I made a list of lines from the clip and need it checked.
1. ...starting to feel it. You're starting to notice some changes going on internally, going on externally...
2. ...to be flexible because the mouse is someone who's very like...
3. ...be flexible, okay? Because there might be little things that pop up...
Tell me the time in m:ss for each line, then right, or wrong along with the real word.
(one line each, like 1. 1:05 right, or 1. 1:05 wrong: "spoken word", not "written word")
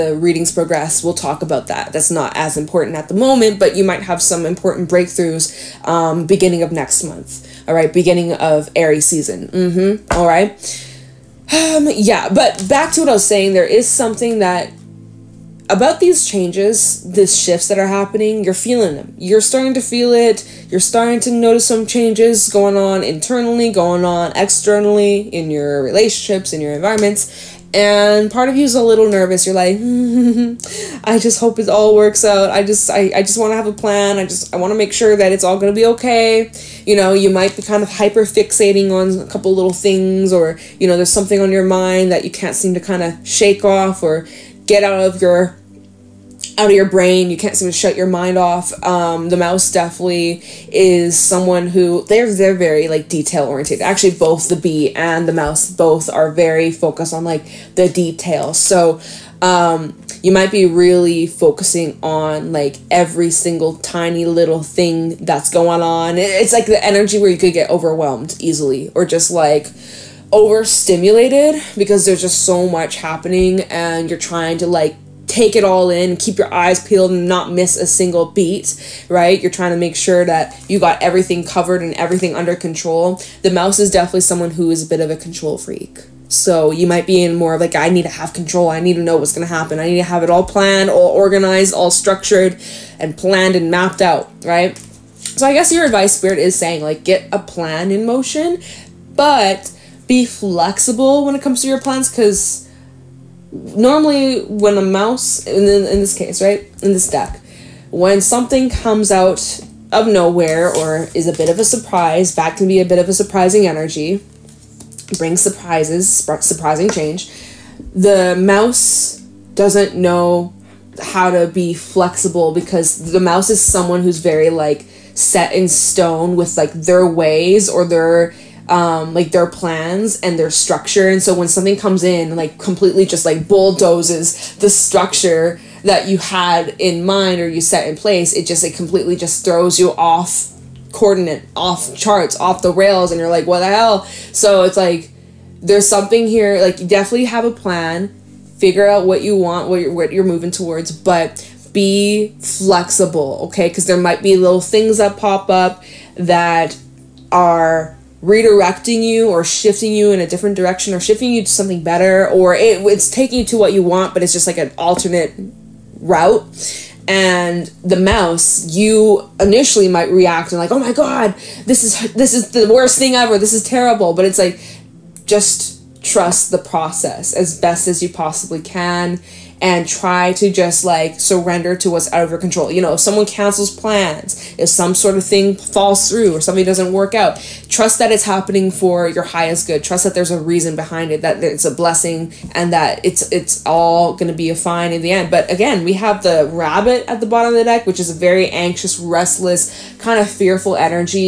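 1. 0:19 right
2. 2:01 right
3. 2:31 right.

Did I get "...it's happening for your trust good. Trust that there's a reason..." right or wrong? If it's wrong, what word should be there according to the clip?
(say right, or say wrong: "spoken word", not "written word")
wrong: "highest", not "trust".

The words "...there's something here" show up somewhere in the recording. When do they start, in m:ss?
2:25.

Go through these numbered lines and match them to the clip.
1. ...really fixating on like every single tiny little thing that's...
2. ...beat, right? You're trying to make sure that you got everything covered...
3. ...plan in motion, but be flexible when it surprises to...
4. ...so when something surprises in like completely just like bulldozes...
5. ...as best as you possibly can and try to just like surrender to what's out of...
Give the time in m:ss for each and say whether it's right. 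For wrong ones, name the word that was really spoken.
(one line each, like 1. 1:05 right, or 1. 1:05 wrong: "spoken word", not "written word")
1. 1:00 wrong: "focusing", not "fixating"
2. 1:18 right
3. 1:37 wrong: "comes", not "surprises"
4. 2:11 wrong: "comes", not "surprises"
5. 2:57 right.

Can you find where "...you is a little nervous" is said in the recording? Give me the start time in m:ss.
0:28.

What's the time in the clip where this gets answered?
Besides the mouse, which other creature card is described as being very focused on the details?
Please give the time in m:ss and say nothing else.
0:54.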